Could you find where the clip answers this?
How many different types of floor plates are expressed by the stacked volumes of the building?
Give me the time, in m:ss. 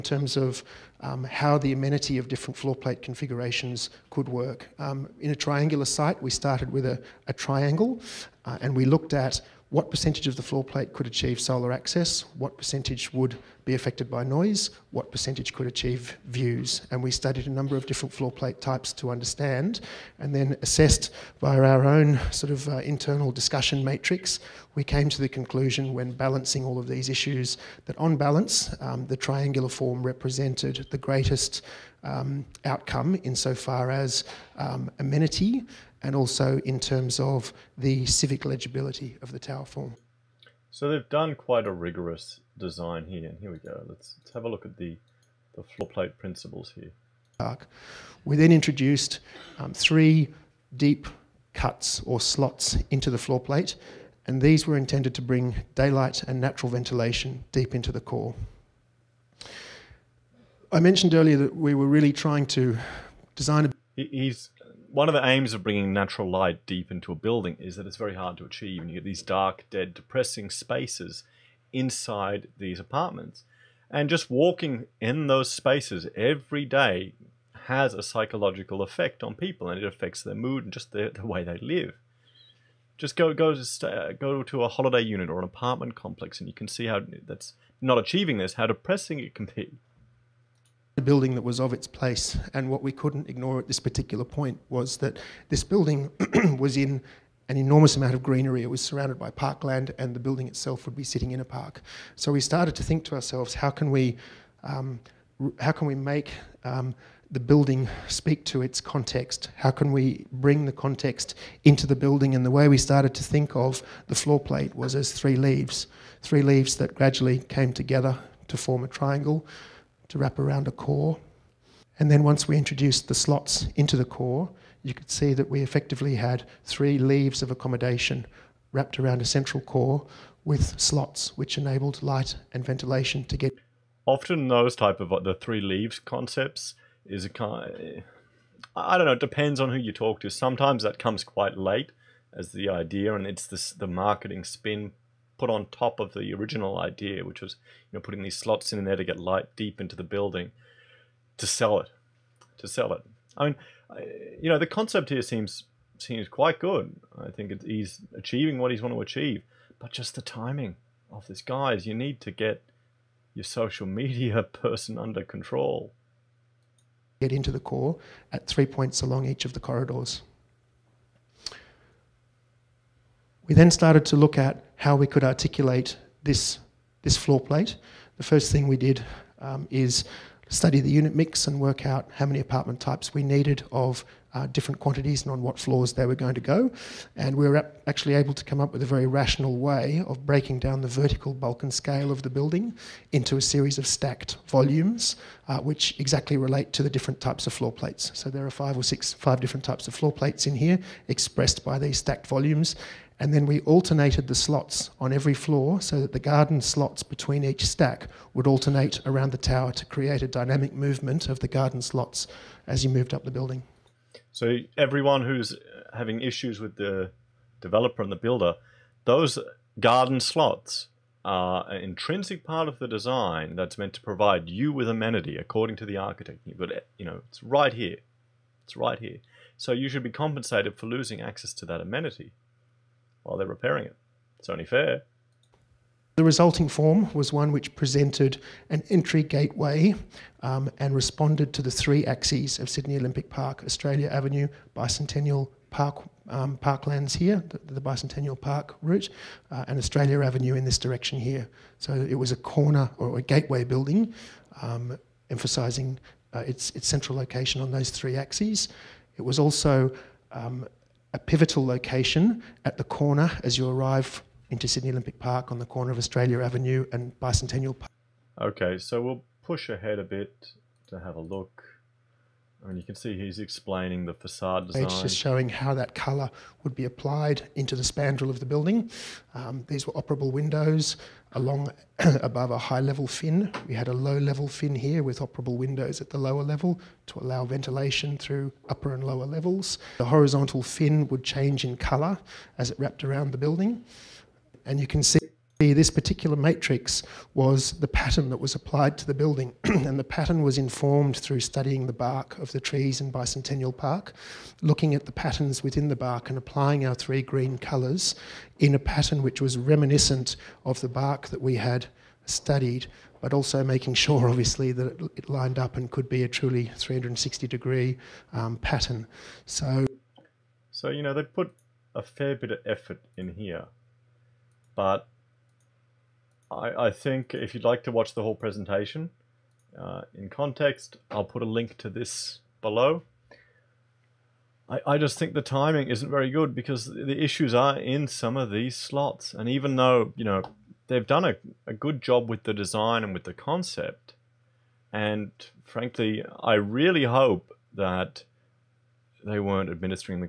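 3:19.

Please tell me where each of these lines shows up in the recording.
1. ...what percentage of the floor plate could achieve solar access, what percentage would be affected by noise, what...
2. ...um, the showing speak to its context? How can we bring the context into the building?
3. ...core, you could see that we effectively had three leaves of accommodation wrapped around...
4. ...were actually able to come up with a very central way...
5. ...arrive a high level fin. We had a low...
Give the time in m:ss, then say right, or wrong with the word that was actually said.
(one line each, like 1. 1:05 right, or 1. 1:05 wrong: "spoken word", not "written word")
1. 0:09 right
2. 1:46 wrong: "building", not "showing"
3. 2:04 right
4. 3:07 wrong: "rational", not "central"
5. 4:41 wrong: "above", not "arrive".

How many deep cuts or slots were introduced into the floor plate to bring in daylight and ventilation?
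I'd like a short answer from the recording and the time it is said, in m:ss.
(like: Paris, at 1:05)
3, at 0:49.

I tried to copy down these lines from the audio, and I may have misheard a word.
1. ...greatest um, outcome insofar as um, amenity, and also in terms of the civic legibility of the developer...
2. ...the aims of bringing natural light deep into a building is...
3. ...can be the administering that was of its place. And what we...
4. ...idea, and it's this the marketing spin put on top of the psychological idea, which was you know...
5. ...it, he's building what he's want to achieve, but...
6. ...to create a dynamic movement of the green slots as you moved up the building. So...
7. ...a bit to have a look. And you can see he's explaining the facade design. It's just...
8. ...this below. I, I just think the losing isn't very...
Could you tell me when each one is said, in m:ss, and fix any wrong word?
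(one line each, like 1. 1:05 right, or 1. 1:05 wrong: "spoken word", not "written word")
1. 0:30 wrong: "tower", not "developer"
2. 1:05 right
3. 1:29 wrong: "building", not "administering"
4. 2:22 wrong: "original", not "psychological"
5. 2:37 wrong: "achieving", not "building"
6. 3:29 wrong: "garden", not "green"
7. 4:29 right
8. 5:31 wrong: "timing", not "losing".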